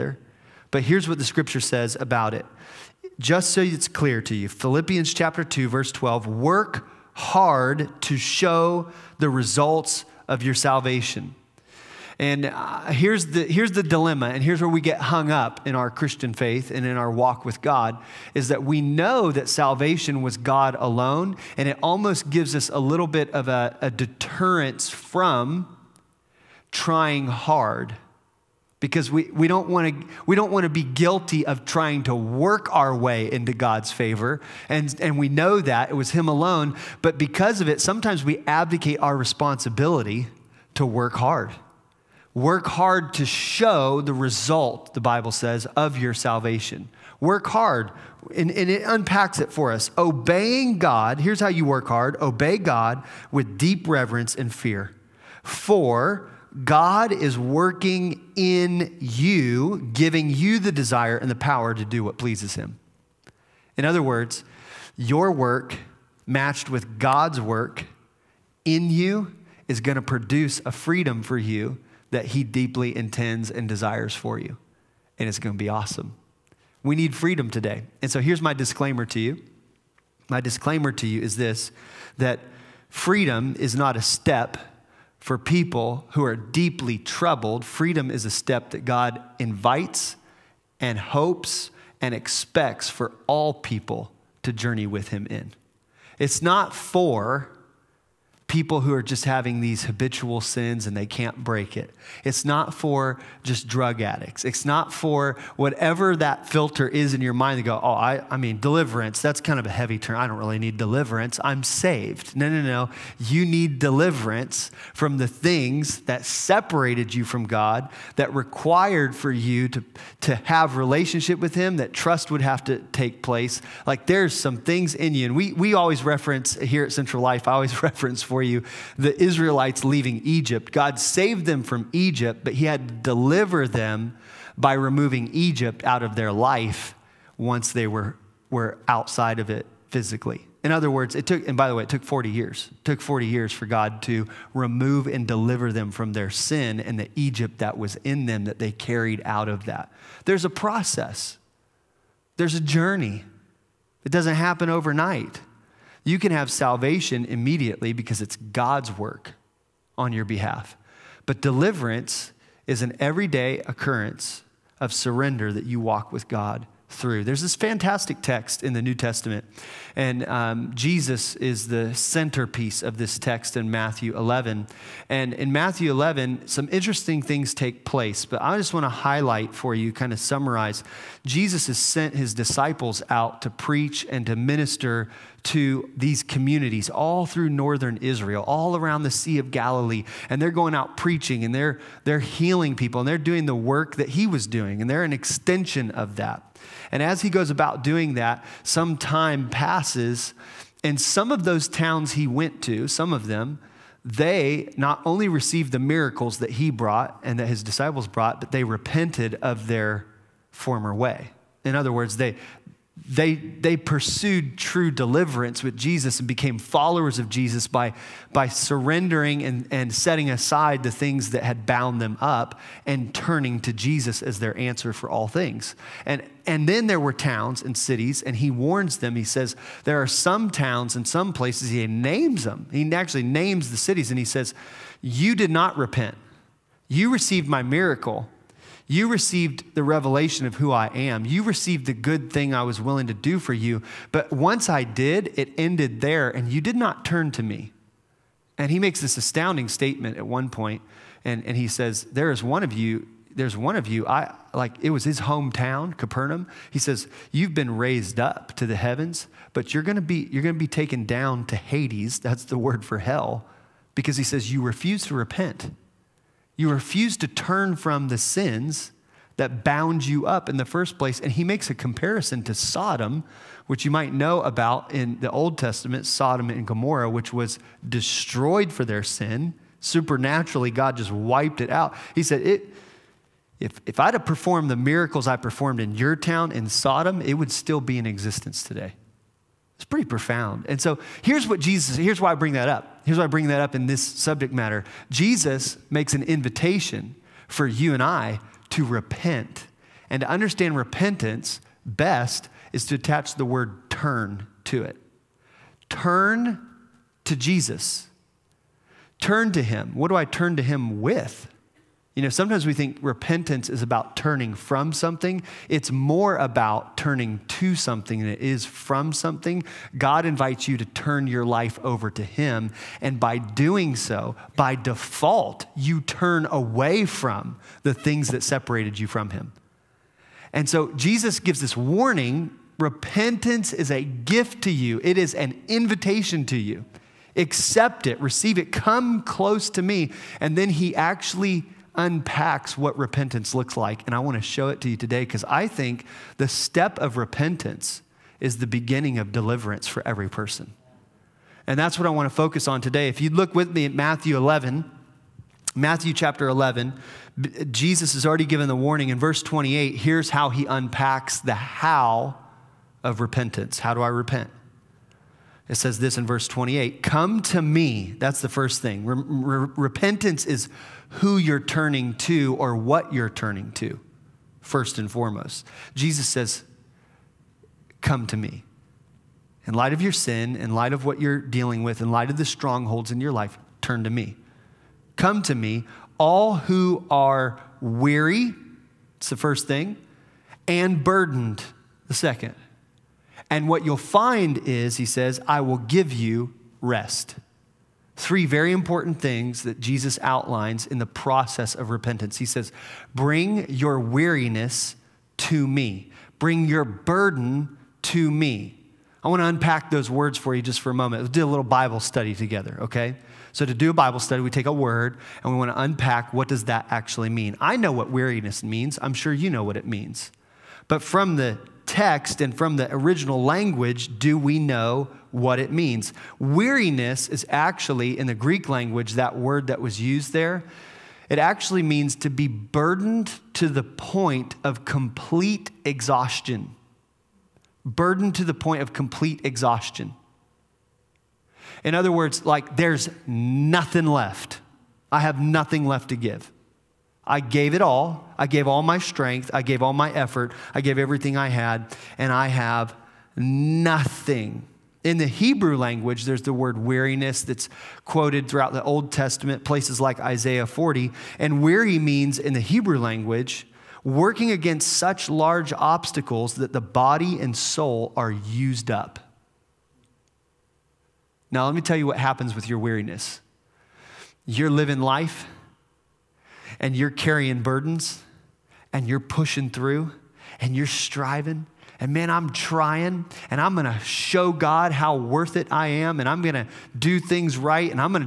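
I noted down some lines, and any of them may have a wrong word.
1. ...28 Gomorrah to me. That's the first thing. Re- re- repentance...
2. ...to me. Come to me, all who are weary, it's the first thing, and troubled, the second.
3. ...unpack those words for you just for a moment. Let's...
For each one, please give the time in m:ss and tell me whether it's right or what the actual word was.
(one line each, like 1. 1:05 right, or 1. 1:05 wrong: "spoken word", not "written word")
1. 6:06 wrong: "Come", not "Gomorrah"
2. 6:24 wrong: "burdened", not "troubled"
3. 6:49 right.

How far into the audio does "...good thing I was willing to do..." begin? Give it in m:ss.
4:01.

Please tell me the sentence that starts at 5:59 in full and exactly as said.
Here's how he unpacks the how of repentance.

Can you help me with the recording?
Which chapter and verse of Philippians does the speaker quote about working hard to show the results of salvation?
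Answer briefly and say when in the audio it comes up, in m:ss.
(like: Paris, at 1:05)
Chapter 2, verse 12, at 0:04.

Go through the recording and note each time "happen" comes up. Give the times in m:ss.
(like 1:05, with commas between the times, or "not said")
2:34, 7:52.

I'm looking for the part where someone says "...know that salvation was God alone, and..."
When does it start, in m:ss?
0:18.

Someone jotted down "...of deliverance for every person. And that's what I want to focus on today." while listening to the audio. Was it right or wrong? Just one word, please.
right.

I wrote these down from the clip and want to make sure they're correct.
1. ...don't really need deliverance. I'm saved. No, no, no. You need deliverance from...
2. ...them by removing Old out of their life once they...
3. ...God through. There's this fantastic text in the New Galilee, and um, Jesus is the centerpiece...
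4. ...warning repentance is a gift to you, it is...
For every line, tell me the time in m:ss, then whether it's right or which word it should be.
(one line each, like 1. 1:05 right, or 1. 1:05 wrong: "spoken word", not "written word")
1. 1:50 right
2. 2:13 wrong: "Egypt", not "Old"
3. 2:46 wrong: "Testament", not "Galilee"
4. 5:31 right.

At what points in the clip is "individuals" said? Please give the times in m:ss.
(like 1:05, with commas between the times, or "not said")
not said.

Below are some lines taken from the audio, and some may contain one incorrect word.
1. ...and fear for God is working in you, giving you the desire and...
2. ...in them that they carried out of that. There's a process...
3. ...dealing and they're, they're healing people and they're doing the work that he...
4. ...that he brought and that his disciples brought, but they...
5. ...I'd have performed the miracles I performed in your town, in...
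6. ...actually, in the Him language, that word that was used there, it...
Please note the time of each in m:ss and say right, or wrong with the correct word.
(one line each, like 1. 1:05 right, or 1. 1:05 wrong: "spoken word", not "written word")
1. 0:54 right
2. 2:28 right
3. 3:10 wrong: "preaching", not "dealing"
4. 3:26 right
5. 4:43 right
6. 7:07 wrong: "Greek", not "Him".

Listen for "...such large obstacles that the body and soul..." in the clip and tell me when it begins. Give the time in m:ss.
7:44.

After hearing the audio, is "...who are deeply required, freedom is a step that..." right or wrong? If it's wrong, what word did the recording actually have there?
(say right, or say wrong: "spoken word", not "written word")
wrong: "troubled", not "required".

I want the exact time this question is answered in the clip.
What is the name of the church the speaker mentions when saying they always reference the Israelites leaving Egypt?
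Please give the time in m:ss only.
2:06.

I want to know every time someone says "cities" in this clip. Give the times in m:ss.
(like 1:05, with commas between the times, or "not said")
3:47, 3:53.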